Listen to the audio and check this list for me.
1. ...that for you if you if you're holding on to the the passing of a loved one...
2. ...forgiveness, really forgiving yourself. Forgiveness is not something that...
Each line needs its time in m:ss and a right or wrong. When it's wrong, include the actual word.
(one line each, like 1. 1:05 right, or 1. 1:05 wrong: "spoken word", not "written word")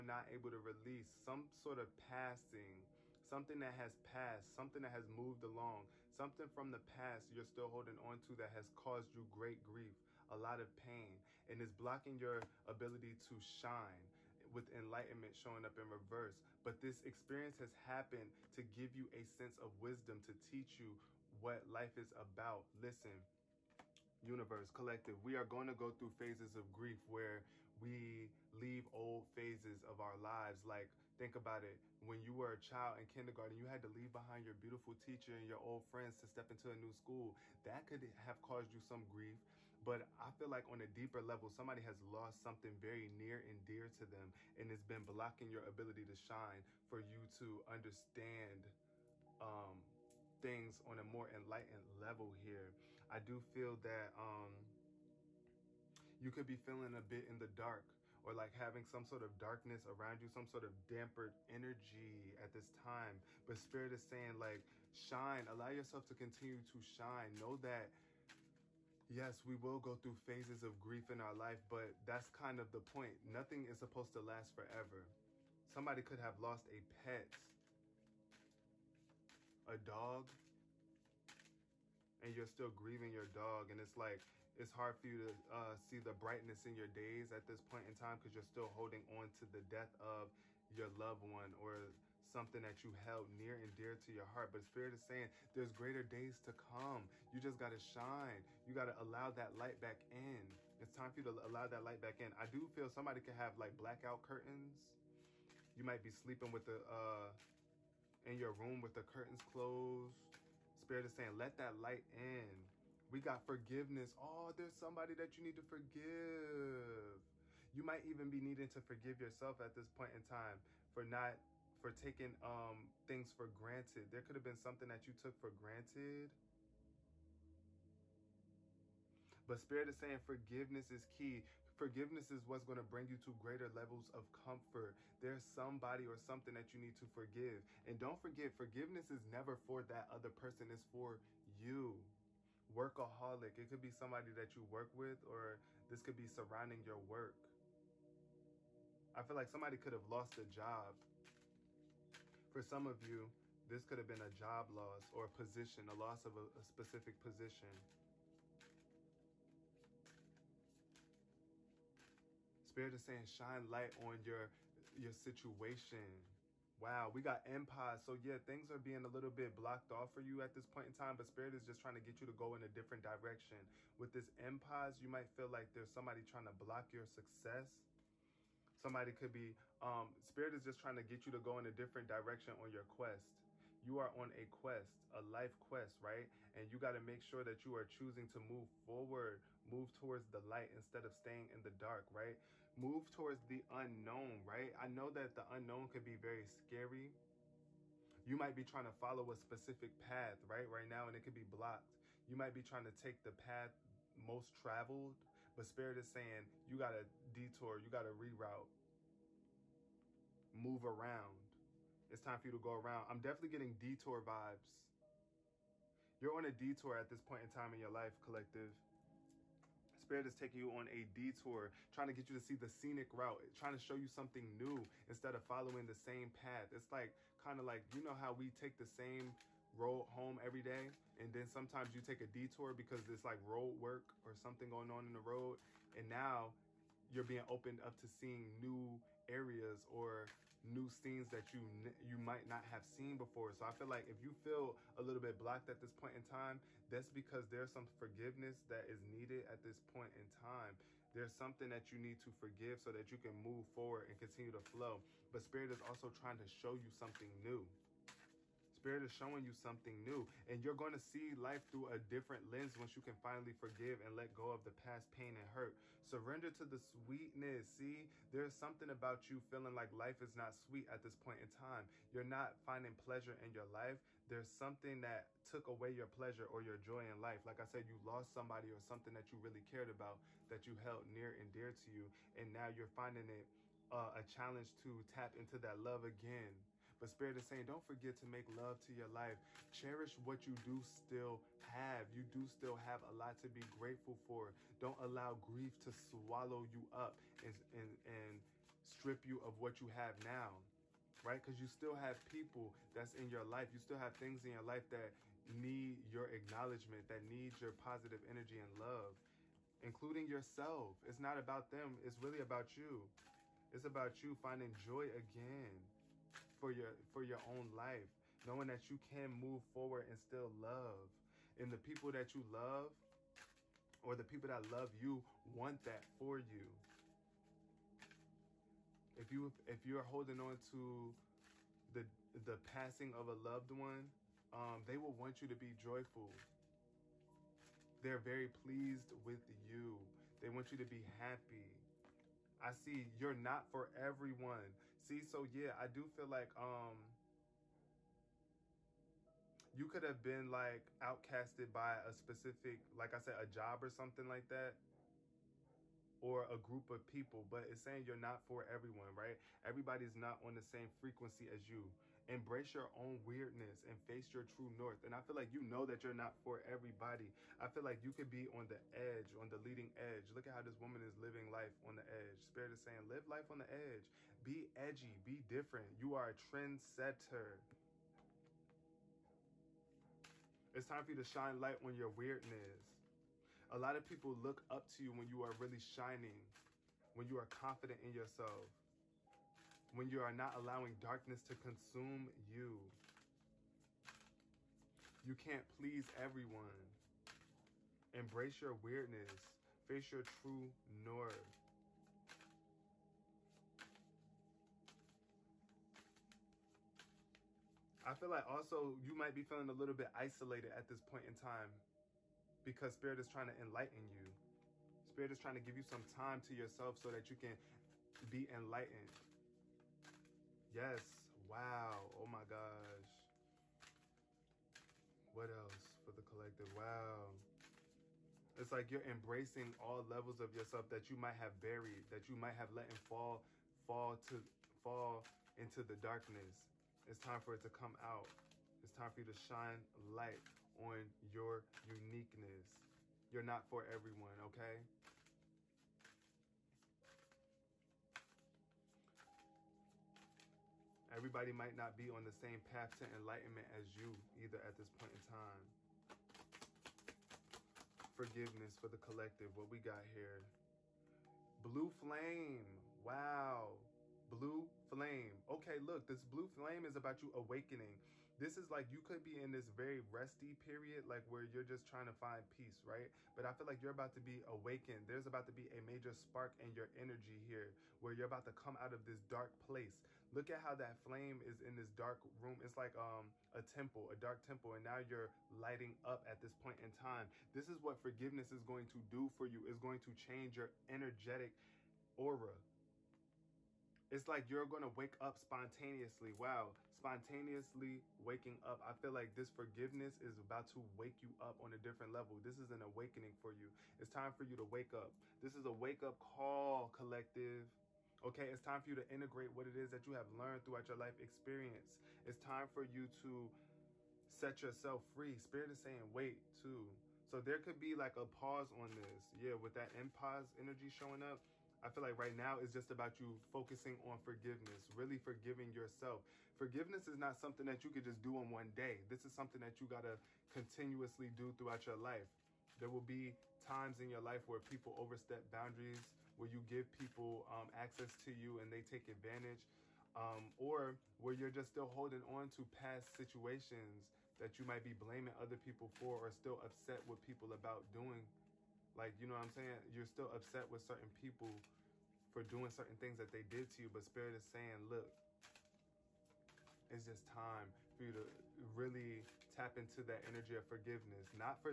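1. 5:25 right
2. 8:44 right.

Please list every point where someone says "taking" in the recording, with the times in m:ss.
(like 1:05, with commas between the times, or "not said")
2:01, 3:40.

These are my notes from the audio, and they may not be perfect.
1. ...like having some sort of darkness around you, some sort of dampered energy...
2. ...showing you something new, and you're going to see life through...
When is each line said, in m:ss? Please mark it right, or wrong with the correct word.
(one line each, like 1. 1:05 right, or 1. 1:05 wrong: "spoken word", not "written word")
1. 0:58 right
2. 4:19 right.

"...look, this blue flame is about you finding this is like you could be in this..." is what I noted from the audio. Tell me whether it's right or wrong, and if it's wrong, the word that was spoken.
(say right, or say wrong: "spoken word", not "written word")
wrong: "awakening", not "finding".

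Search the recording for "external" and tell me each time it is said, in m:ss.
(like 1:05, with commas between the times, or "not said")
not said.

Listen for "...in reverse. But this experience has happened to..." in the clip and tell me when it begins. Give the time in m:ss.
0:15.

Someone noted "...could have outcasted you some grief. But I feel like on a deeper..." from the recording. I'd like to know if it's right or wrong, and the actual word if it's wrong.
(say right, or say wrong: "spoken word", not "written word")
wrong: "caused", not "outcasted".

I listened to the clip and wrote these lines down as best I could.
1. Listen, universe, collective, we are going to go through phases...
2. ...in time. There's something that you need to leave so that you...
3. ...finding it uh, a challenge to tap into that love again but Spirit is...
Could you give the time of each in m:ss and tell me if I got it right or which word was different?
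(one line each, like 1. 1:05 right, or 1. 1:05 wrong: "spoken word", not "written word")
1. 0:22 right
2. 4:10 wrong: "forgive", not "leave"
3. 4:42 right.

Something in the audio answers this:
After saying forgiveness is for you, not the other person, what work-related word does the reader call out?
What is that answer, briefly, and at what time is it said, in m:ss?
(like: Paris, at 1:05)
workaholic, at 2:22.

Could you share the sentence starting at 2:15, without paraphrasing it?
There's somebody or something that you need to forgive.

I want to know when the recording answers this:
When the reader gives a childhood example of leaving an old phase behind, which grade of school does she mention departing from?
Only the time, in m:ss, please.
0:33.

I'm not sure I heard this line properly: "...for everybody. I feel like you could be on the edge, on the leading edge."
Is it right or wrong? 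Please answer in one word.
right.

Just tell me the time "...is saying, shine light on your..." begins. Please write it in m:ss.
2:42.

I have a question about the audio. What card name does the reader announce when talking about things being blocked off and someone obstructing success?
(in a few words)
Empire.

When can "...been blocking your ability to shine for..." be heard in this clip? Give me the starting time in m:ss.
0:44.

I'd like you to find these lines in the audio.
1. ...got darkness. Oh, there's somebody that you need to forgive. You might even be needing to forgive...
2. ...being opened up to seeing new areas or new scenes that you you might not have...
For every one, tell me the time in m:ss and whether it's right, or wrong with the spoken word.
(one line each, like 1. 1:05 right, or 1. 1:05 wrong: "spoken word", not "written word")
1. 1:53 wrong: "forgiveness", not "darkness"
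2. 3:57 right.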